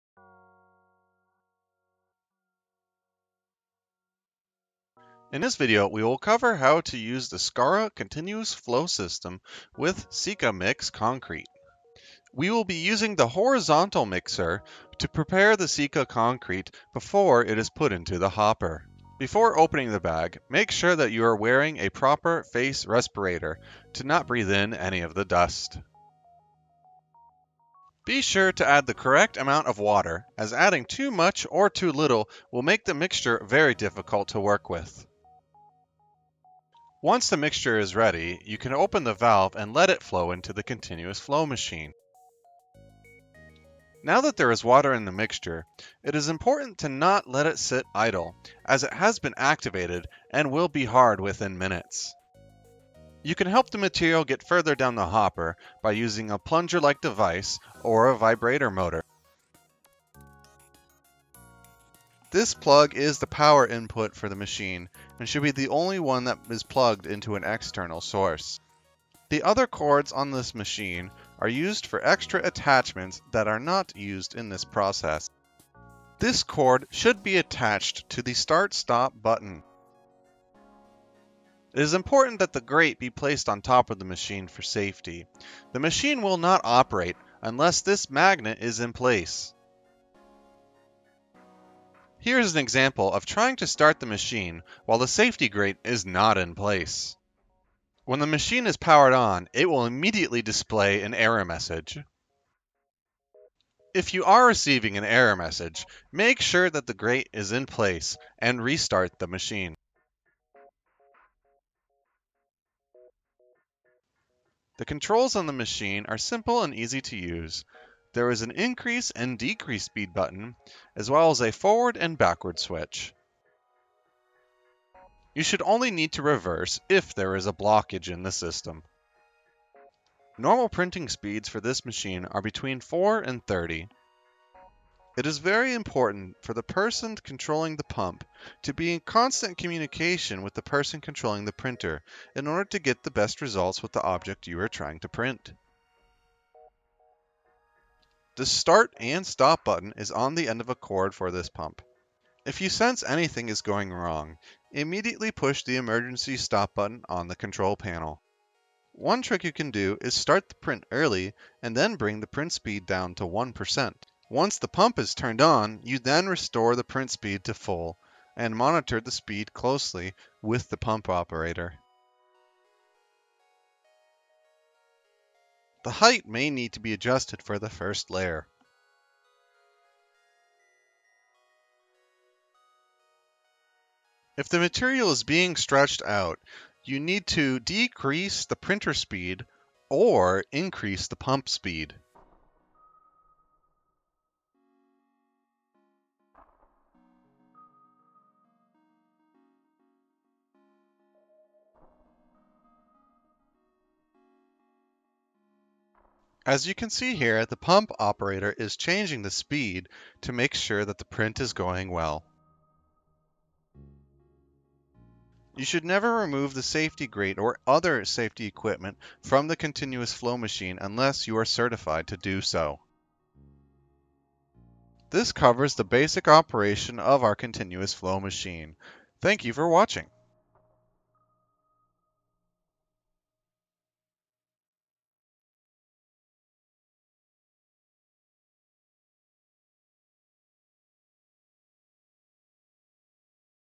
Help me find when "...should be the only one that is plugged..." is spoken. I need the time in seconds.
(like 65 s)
65 s.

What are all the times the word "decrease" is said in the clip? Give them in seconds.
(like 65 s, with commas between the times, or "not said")
119 s, 187 s.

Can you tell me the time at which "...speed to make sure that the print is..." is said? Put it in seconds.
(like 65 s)
209 s.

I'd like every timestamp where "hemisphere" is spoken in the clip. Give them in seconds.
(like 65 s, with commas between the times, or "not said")
not said.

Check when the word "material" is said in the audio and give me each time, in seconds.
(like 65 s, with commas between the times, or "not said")
53 s, 184 s.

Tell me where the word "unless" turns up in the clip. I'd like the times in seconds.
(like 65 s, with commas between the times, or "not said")
87 s, 220 s.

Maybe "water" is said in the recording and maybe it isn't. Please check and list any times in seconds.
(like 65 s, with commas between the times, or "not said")
29 s, 44 s.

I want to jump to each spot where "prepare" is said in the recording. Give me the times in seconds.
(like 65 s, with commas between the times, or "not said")
15 s.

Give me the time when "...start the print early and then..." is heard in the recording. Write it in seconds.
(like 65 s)
160 s.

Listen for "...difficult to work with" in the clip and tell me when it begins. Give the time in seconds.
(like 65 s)
33 s.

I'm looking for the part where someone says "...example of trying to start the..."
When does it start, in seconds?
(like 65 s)
92 s.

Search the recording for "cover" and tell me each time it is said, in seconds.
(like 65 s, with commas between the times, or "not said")
6 s, 225 s.